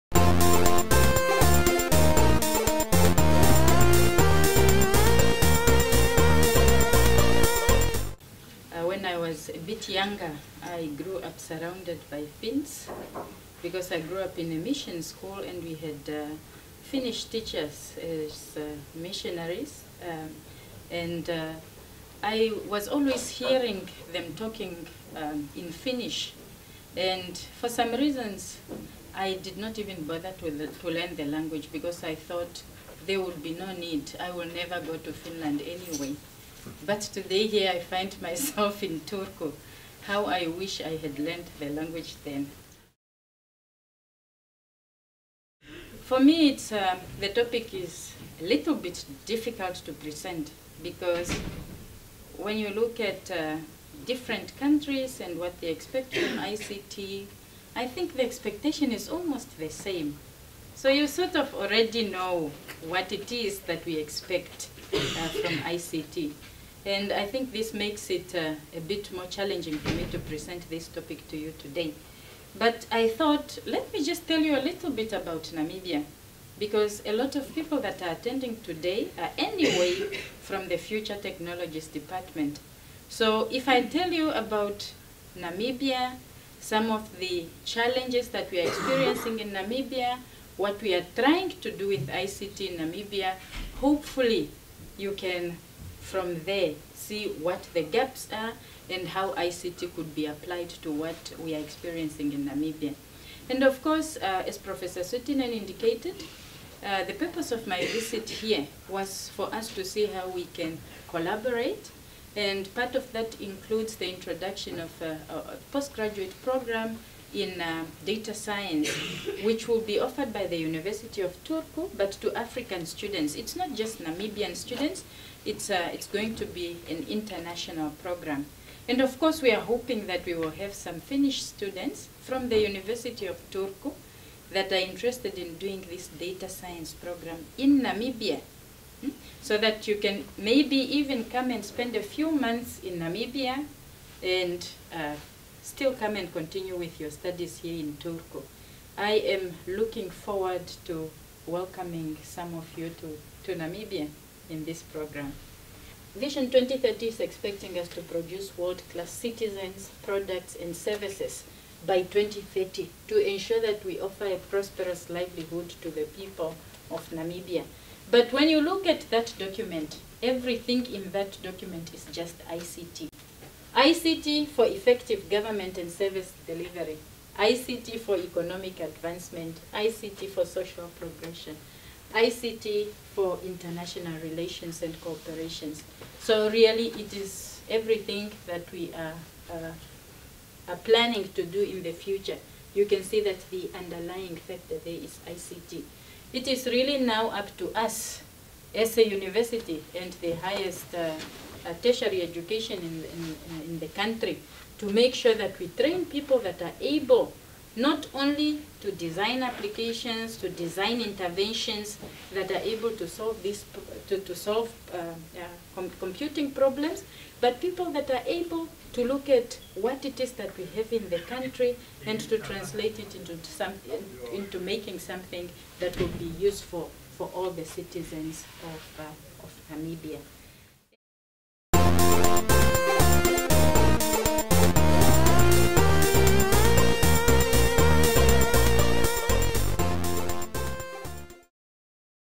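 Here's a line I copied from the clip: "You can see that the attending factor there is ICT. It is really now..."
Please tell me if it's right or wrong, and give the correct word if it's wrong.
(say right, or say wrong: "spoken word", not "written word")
wrong: "underlying", not "attending".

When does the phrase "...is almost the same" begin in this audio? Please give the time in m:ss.
0:58.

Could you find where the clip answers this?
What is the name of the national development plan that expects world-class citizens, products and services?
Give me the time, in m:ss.
2:36.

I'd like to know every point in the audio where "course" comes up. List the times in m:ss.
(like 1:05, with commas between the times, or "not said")
1:43, 2:09.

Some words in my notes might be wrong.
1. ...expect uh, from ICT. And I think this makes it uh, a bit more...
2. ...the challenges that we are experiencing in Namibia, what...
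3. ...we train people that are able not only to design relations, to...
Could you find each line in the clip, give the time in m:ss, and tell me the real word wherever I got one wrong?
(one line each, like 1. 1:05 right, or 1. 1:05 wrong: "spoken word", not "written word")
1. 1:03 right
2. 1:27 right
3. 3:25 wrong: "applications", not "relations".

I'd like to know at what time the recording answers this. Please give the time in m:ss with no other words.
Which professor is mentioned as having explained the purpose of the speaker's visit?
1:44.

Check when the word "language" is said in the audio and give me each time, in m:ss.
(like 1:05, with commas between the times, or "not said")
0:31, 0:41.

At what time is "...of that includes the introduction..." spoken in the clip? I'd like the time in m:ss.
1:52.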